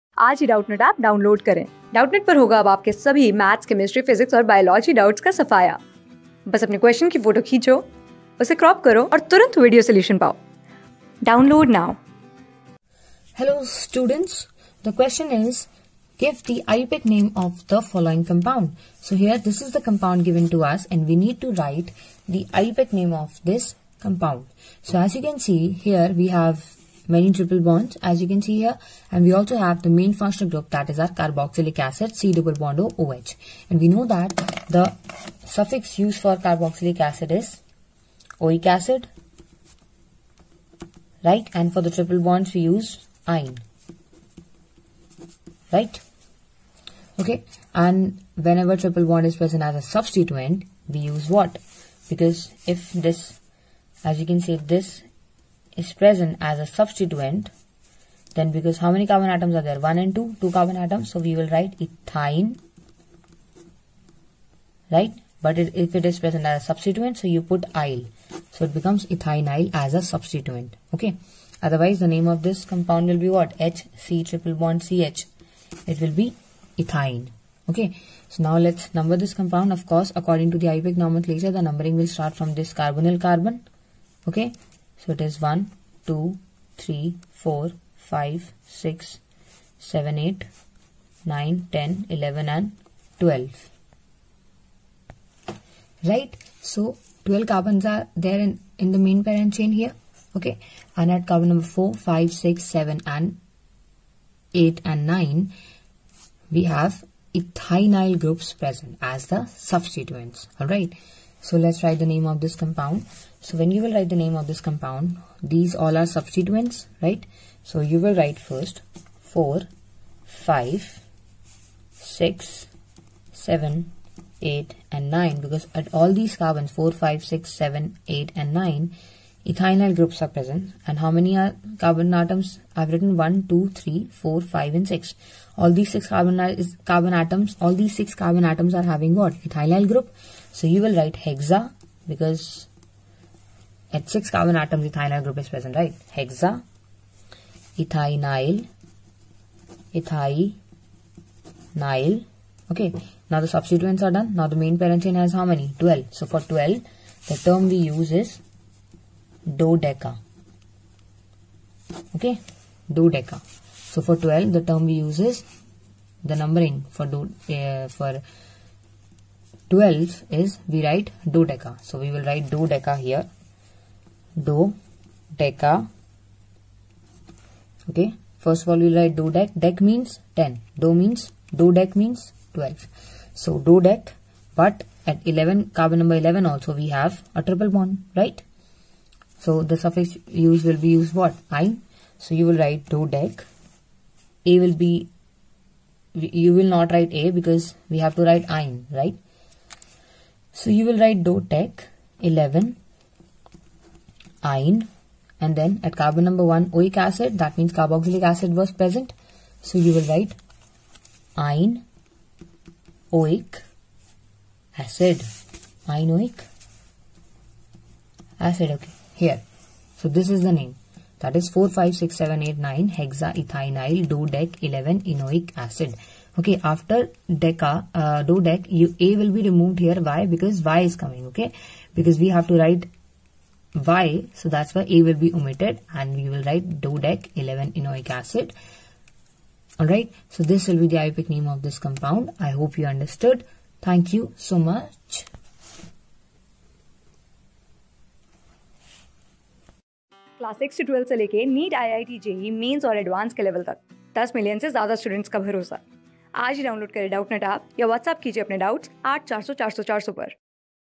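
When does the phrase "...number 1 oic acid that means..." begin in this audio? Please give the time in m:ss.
3:26.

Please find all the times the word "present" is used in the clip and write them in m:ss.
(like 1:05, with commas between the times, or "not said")
0:49, 0:55, 1:06, 1:48, 2:10, 2:25, 3:28.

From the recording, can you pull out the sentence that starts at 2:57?
Okay, first of all, we write do Dec Dec means 10.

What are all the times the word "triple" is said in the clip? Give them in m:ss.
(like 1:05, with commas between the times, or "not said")
0:27, 0:41, 0:48, 1:14, 3:07.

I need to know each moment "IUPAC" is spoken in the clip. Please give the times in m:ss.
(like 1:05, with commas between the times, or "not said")
1:20, 4:01.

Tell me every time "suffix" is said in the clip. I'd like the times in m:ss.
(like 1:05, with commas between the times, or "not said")
0:35, 3:09.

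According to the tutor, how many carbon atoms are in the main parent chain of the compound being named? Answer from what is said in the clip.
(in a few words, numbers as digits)
12.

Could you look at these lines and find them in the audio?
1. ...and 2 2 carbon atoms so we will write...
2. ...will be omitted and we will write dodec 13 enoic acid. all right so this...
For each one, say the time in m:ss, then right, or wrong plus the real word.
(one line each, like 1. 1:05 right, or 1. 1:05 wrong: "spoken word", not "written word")
1. 0:59 right
2. 3:55 wrong: "11", not "13".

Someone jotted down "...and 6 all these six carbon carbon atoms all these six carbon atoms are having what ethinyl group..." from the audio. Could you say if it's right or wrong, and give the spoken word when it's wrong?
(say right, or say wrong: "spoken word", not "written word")
right.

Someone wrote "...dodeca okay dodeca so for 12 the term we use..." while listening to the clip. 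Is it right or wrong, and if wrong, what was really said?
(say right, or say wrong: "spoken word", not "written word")
right.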